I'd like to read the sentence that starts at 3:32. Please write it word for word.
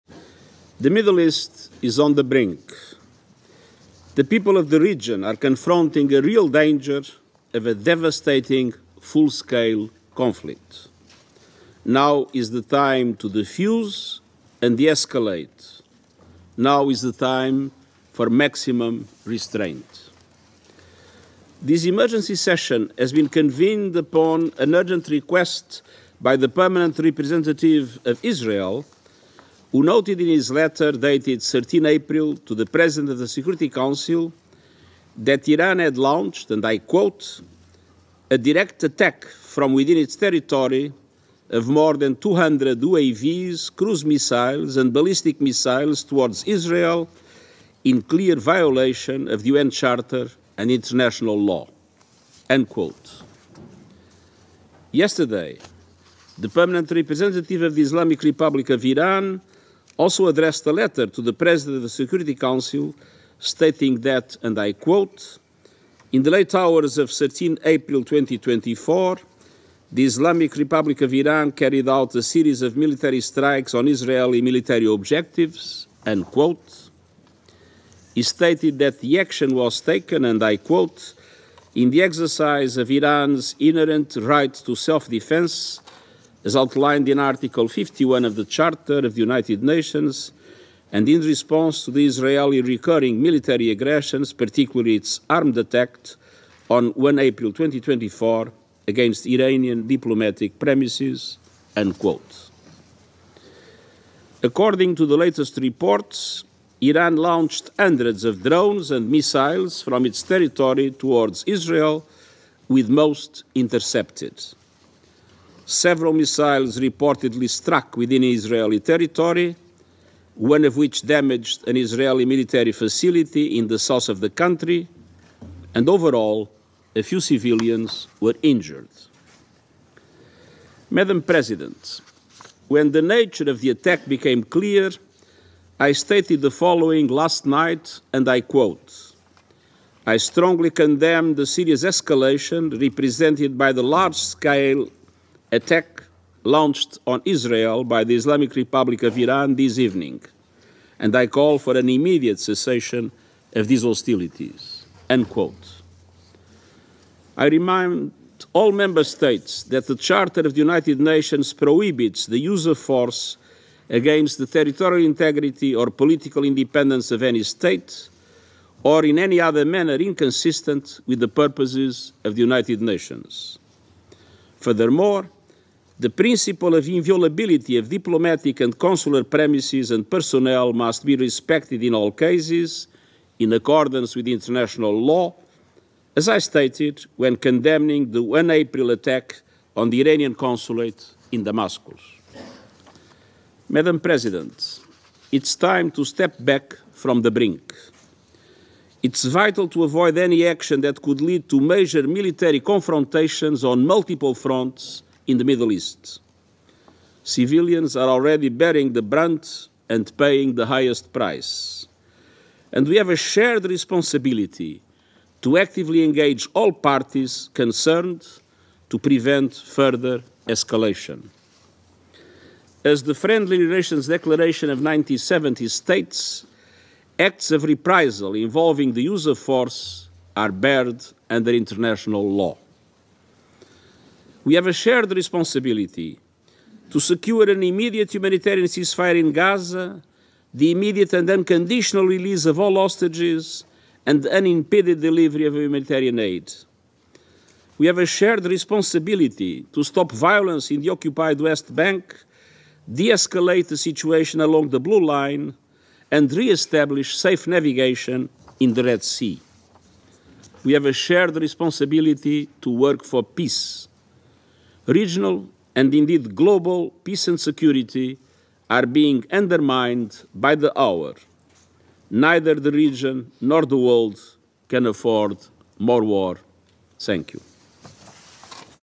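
And we have a shared responsibility to actively engage all parties concerned to prevent further escalation.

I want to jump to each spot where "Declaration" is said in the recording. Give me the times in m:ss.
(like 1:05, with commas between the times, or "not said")
3:44.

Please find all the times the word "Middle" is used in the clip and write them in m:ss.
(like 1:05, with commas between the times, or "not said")
0:00, 3:25.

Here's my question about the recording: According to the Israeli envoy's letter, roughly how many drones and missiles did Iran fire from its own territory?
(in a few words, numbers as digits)
more than 200.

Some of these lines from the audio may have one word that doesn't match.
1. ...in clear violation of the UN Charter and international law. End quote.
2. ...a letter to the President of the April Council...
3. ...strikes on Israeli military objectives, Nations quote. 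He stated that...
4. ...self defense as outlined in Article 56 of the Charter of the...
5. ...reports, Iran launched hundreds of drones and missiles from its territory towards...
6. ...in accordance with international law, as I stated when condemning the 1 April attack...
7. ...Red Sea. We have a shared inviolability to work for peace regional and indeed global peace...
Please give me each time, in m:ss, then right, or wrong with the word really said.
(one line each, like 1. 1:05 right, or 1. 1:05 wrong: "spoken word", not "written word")
1. 0:47 right
2. 1:00 wrong: "Security", not "April"
3. 1:13 wrong: "End", not "Nations"
4. 1:24 wrong: "51", not "56"
5. 1:45 right
6. 3:03 right
7. 4:18 wrong: "responsibility", not "inviolability".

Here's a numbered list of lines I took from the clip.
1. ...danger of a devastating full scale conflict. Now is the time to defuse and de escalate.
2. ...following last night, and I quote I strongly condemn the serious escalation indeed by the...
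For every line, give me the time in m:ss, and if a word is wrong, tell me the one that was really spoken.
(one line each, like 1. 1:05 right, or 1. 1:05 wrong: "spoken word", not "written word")
1. 0:06 right
2. 2:16 wrong: "represented", not "indeed".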